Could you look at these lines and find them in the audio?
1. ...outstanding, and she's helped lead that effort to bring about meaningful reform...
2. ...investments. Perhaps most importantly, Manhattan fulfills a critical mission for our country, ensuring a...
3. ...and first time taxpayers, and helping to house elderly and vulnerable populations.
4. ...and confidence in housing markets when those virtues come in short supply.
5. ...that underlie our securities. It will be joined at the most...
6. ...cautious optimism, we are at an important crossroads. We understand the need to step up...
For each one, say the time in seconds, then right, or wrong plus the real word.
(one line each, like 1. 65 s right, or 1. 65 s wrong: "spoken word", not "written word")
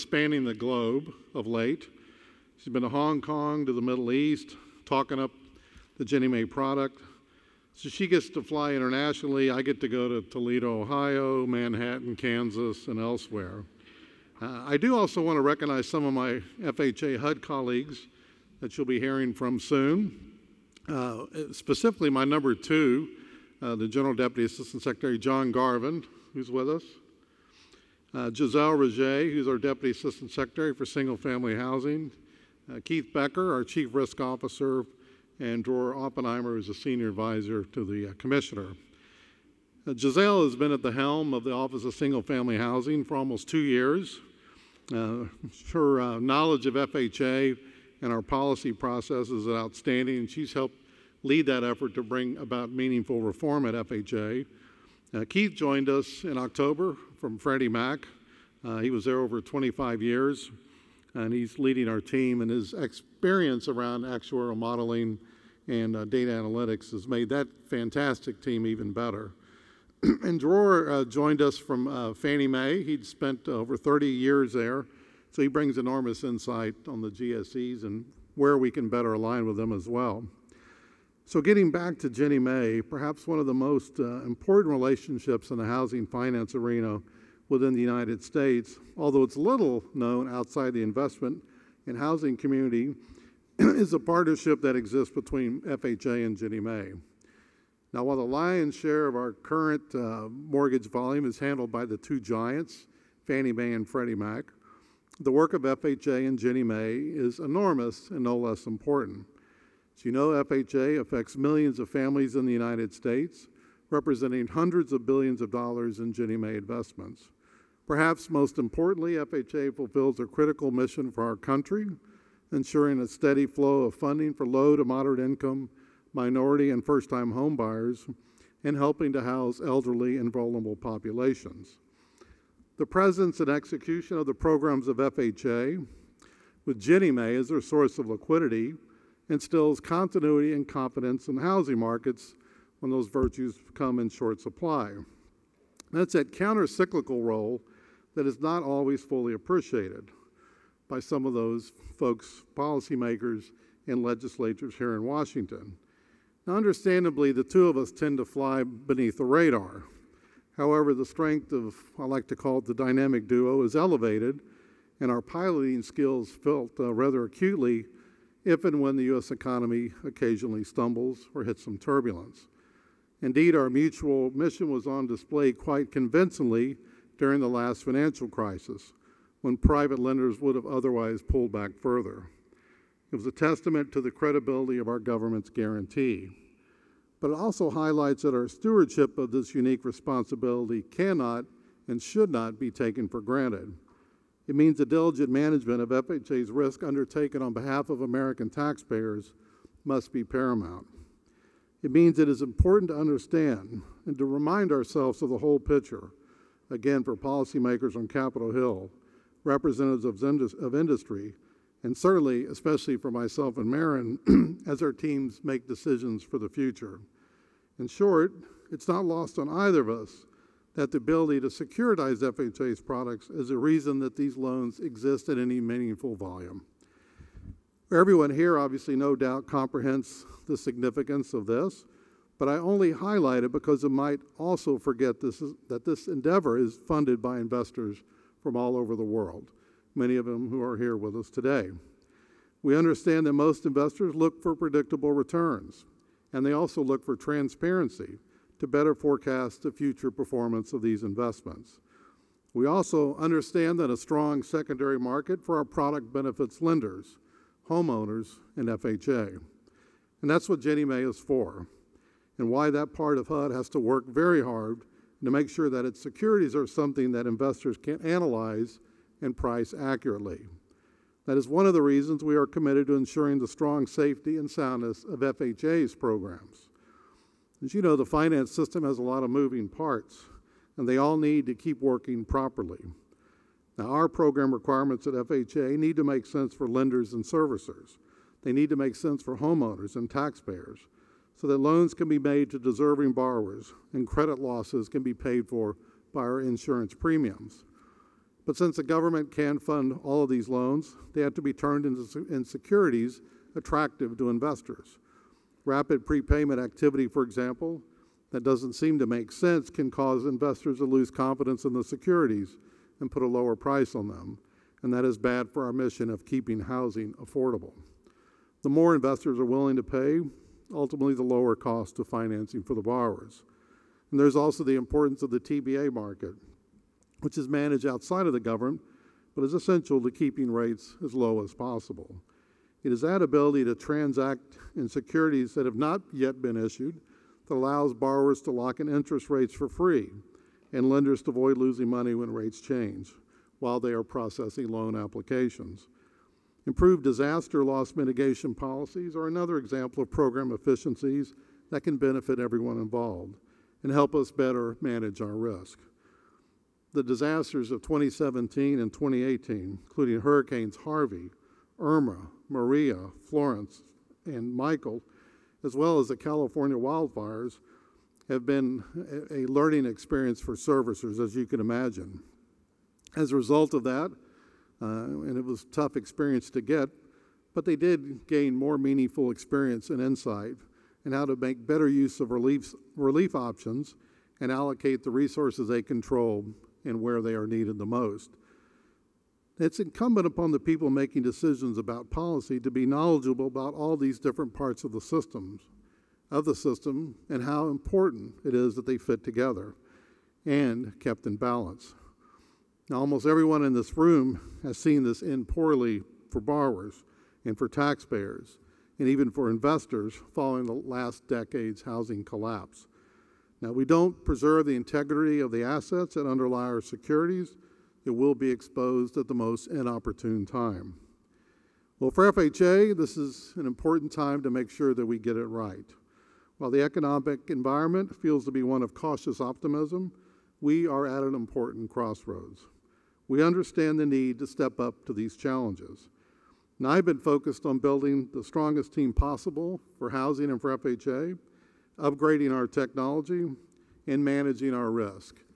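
1. 49 s right
2. 116 s wrong: "FHA", not "Manhattan"
3. 126 s wrong: "homebuyers", not "taxpayers"
4. 140 s right
5. 416 s wrong: "exposed", not "joined"
6. 428 s right.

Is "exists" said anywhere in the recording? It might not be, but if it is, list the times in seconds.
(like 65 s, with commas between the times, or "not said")
94 s, 224 s.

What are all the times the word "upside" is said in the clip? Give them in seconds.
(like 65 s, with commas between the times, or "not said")
not said.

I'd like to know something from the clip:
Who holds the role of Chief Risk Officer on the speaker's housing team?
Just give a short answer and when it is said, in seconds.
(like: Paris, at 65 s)
Keith Becker, at 32 s.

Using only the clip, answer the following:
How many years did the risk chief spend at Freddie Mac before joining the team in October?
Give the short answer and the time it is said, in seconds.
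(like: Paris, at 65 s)
25, at 59 s.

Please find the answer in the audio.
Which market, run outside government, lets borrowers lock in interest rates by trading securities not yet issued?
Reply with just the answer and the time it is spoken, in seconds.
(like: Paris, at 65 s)
TBA market, at 325 s.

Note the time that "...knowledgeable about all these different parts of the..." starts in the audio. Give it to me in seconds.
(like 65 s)
392 s.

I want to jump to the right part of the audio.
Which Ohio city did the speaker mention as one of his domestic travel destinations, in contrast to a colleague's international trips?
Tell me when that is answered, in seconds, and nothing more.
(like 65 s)
10 s.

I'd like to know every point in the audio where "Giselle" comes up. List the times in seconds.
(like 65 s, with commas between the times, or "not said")
28 s, 39 s.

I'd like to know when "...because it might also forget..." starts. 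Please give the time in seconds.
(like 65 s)
233 s.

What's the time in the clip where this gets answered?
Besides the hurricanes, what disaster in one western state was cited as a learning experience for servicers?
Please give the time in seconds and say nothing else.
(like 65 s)
366 s.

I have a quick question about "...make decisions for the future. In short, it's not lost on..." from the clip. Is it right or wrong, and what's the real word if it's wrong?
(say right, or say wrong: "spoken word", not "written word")
right.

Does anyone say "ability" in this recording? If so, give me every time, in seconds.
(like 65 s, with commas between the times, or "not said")
220 s, 333 s.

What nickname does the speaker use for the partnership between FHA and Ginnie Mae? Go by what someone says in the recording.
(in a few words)
the dynamic duo.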